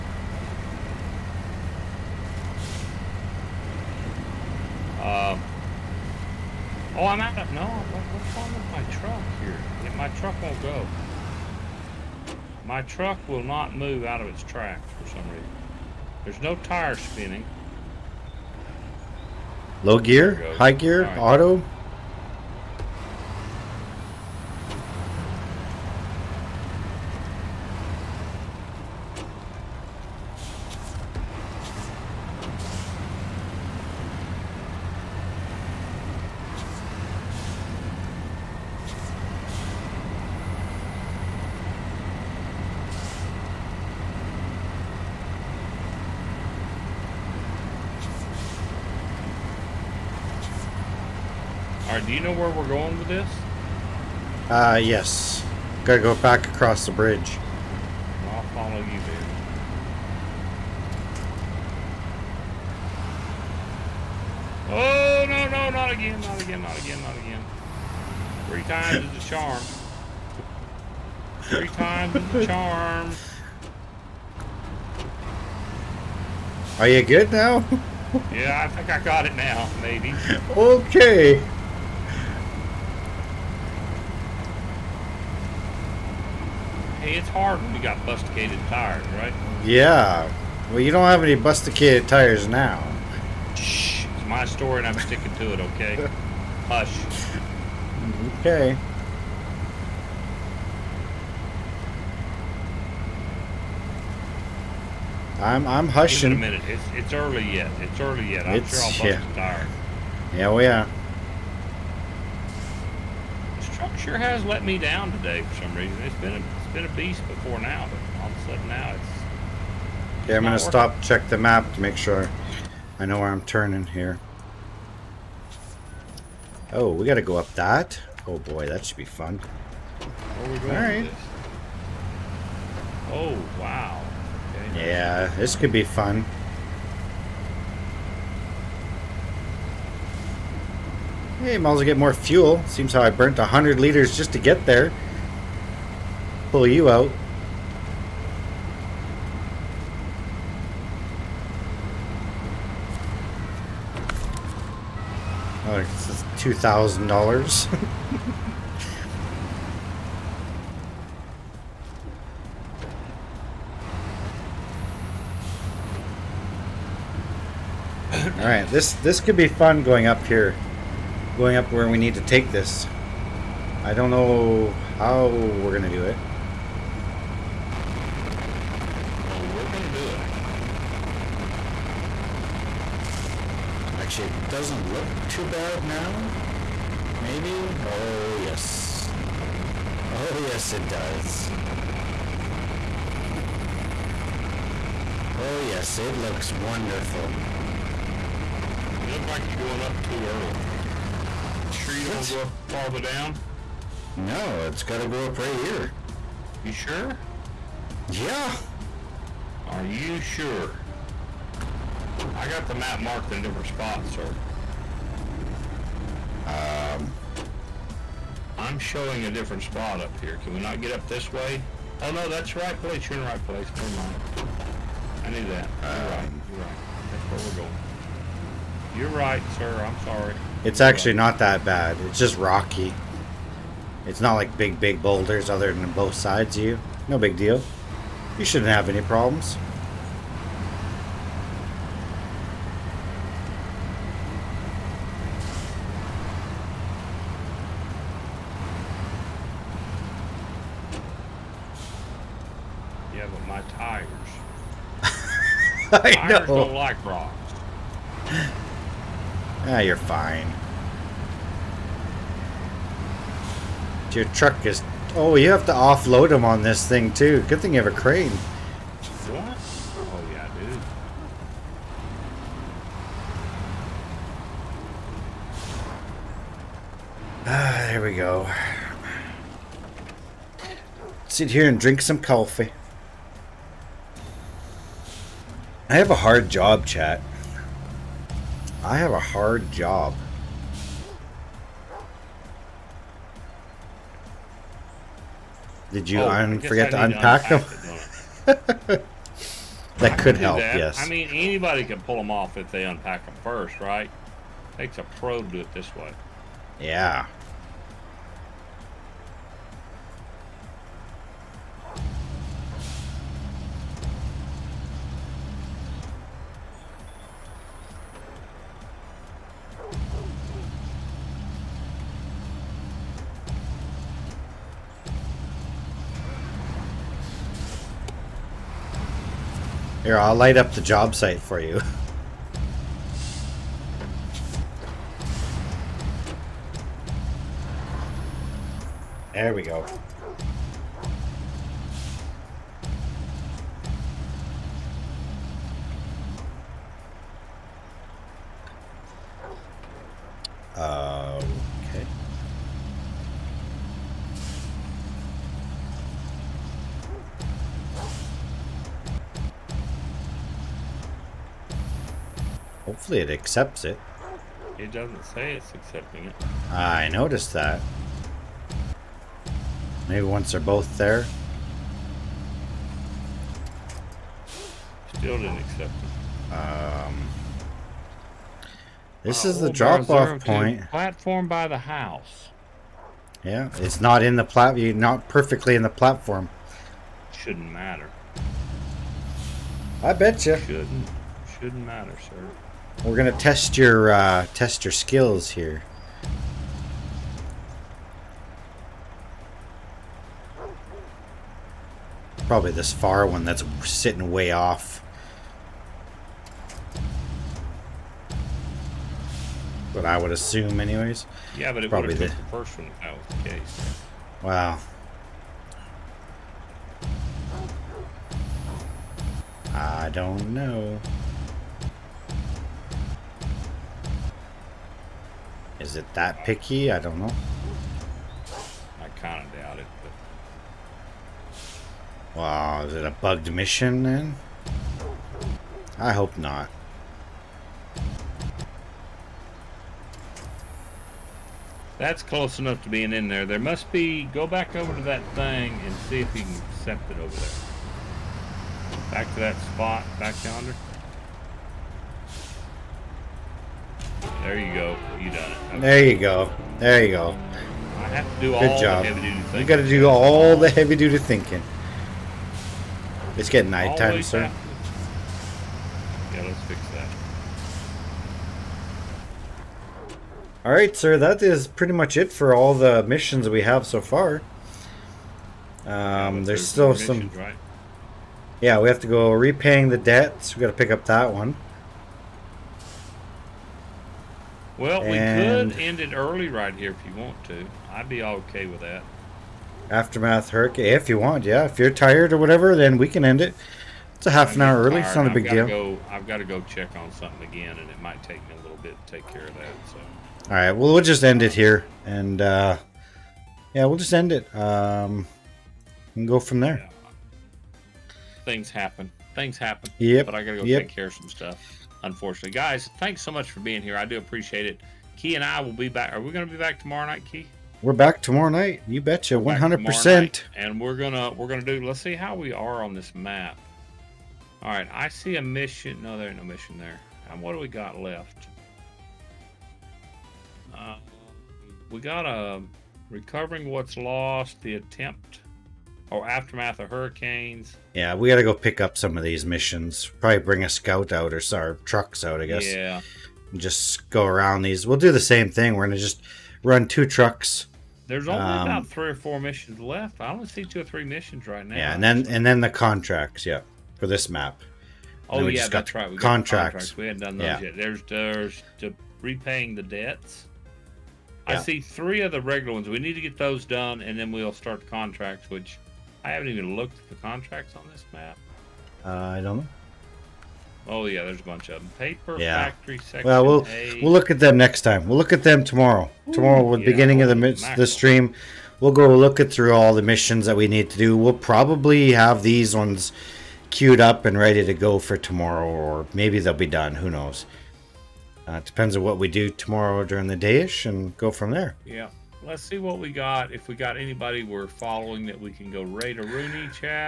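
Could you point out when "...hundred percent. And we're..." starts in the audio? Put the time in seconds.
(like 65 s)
519 s.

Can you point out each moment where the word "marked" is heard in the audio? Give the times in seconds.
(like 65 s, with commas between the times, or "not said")
213 s.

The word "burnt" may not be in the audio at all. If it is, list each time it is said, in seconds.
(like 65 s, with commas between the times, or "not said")
143 s.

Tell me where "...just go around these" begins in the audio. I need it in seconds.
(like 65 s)
543 s.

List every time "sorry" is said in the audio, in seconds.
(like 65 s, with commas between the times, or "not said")
230 s.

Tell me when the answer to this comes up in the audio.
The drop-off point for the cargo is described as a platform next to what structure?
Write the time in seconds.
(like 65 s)
380 s.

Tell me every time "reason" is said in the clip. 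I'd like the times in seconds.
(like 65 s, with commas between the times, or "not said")
15 s, 115 s.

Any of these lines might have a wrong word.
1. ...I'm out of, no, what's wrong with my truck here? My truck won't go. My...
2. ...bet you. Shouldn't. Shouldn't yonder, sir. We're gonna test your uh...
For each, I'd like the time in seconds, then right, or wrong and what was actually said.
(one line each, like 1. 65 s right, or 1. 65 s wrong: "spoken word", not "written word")
1. 7 s right
2. 390 s wrong: "matter", not "yonder".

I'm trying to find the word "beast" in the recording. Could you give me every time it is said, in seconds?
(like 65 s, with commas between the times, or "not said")
116 s.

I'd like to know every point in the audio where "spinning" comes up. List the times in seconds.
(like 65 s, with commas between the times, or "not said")
16 s.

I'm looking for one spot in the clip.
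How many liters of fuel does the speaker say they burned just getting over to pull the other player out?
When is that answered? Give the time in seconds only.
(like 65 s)
143 s.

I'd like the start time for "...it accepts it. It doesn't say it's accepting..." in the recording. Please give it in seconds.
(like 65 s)
363 s.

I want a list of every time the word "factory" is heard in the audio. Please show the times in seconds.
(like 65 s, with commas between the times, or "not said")
572 s.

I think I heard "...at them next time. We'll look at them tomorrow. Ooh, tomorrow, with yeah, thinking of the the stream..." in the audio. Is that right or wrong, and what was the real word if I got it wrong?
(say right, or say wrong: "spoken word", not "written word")
wrong: "beginning", not "thinking".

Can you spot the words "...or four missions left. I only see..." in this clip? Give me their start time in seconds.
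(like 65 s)
549 s.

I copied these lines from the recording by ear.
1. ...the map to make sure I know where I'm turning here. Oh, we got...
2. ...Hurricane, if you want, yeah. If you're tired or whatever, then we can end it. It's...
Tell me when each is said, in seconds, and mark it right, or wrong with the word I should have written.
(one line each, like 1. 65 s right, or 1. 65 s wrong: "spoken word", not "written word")
1. 121 s right
2. 490 s right.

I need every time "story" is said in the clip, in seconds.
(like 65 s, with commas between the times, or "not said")
94 s.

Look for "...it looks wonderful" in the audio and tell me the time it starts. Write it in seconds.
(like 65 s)
195 s.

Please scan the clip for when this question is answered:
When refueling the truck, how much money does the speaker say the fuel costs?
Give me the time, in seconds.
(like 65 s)
156 s.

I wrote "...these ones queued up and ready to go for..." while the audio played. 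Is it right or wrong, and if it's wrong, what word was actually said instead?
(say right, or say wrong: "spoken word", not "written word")
right.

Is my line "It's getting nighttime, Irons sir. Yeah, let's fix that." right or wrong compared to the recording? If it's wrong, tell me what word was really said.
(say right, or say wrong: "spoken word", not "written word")
wrong: "Always", not "Irons".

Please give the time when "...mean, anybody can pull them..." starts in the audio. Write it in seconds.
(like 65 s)
301 s.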